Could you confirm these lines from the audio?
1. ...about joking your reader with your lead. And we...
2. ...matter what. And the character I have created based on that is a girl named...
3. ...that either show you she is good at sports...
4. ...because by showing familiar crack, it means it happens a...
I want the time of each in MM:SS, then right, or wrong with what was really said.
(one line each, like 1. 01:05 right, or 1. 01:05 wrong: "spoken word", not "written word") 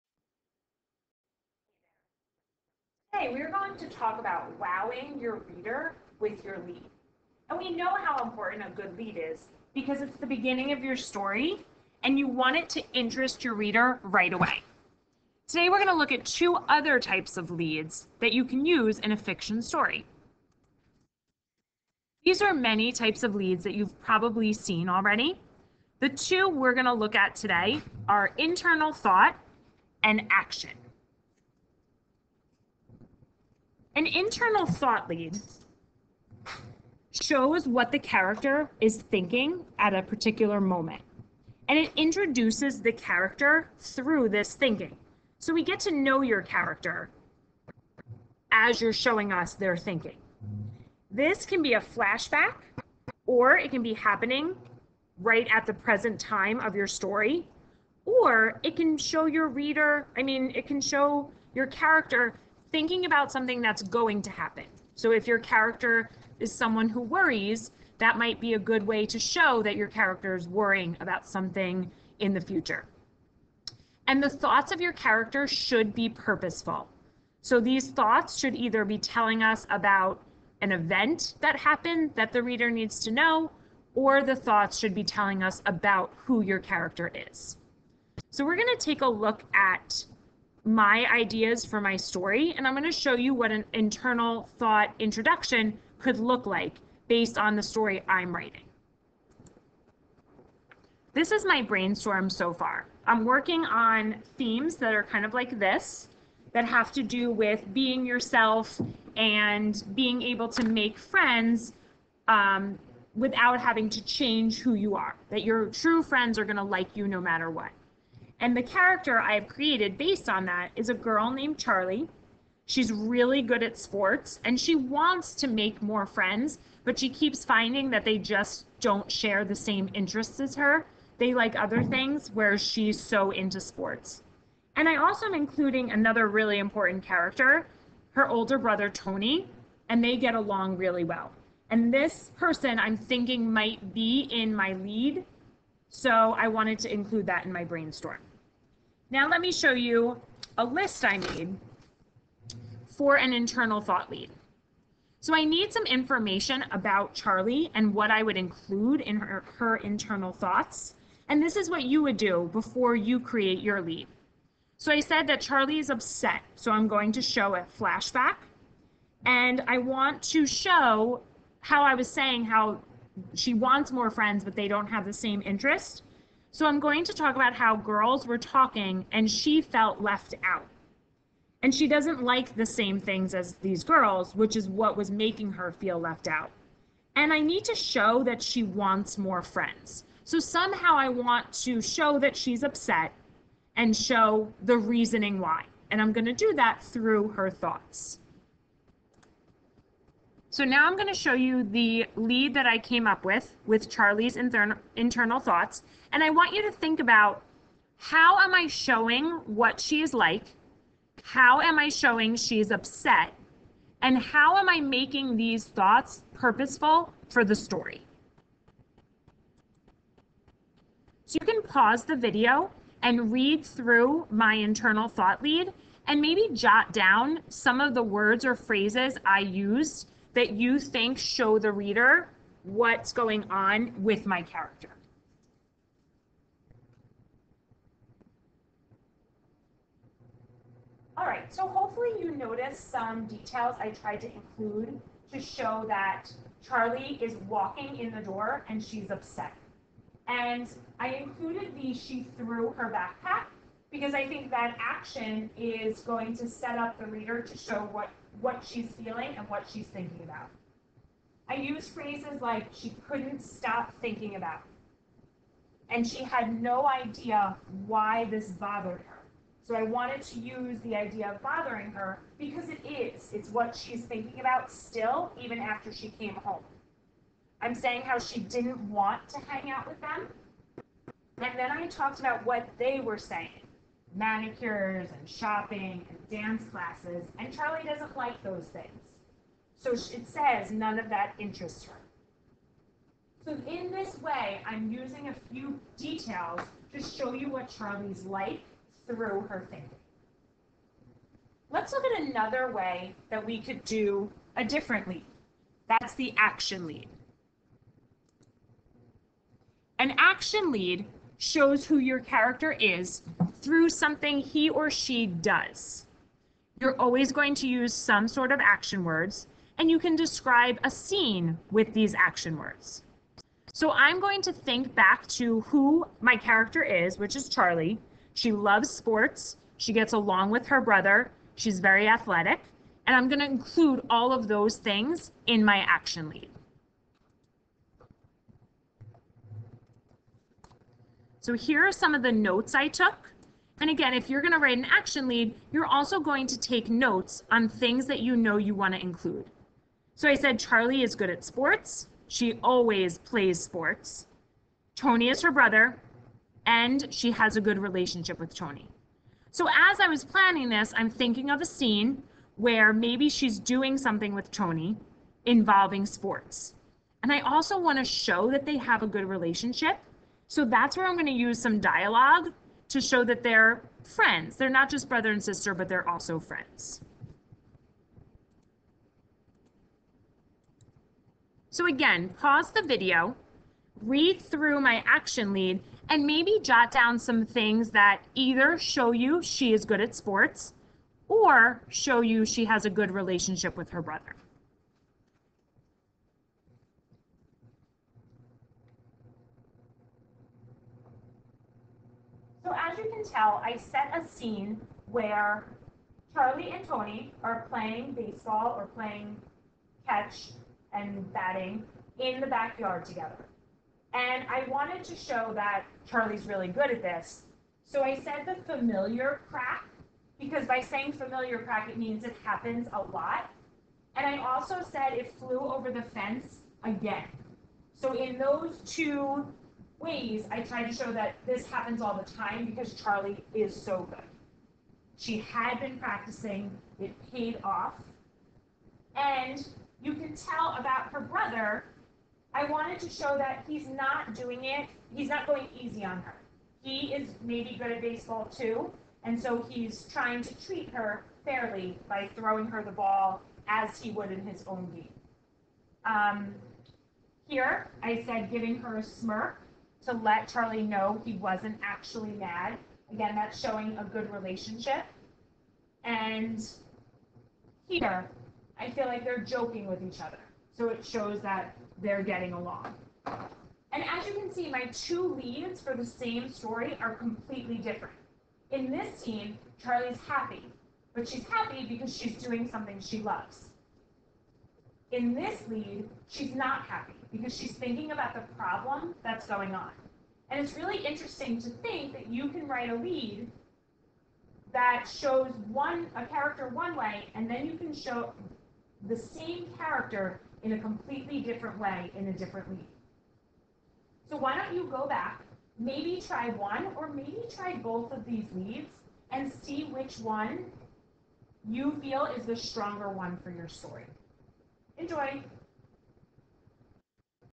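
1. 00:04 wrong: "wowing", not "joking"
2. 01:57 right
3. 06:27 right
4. 07:00 wrong: "saying", not "showing".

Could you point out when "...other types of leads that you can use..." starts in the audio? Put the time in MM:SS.
00:16.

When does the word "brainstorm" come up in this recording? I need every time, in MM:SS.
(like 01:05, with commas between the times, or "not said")
01:41, 02:27.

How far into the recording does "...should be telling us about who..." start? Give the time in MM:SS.
01:24.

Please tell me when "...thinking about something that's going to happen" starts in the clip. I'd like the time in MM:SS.
01:02.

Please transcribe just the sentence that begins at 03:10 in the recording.
So somehow I want to show that she's upset and show the reasoning why.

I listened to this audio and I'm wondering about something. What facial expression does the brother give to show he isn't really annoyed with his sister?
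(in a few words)
A smirk.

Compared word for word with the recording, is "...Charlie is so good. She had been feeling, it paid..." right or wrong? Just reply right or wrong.
wrong.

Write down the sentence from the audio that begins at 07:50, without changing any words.
So it shows that they're getting along.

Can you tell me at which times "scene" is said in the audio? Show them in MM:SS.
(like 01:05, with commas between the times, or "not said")
05:20, 06:01, 06:44, 07:59.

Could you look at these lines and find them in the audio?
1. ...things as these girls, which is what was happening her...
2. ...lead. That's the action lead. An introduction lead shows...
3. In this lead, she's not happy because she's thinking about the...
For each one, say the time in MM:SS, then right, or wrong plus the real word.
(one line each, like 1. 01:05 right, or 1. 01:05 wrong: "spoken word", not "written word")
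1. 03:02 wrong: "making", not "happening"
2. 05:05 wrong: "action", not "introduction"
3. 08:05 right.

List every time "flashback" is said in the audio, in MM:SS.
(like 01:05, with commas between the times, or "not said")
00:51, 02:47.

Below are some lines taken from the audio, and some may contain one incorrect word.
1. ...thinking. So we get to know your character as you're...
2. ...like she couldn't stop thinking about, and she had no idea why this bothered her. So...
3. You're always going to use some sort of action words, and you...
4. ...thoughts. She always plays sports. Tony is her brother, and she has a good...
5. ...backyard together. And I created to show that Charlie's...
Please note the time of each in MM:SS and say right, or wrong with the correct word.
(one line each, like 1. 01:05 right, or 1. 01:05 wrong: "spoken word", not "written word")
1. 00:44 right
2. 04:22 right
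3. 05:16 right
4. 05:51 wrong: "sports", not "thoughts"
5. 06:52 wrong: "wanted", not "created".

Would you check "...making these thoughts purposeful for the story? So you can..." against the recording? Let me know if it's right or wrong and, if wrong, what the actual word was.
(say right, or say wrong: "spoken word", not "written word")
right.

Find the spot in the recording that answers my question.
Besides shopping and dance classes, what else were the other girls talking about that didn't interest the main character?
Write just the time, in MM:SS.
04:44.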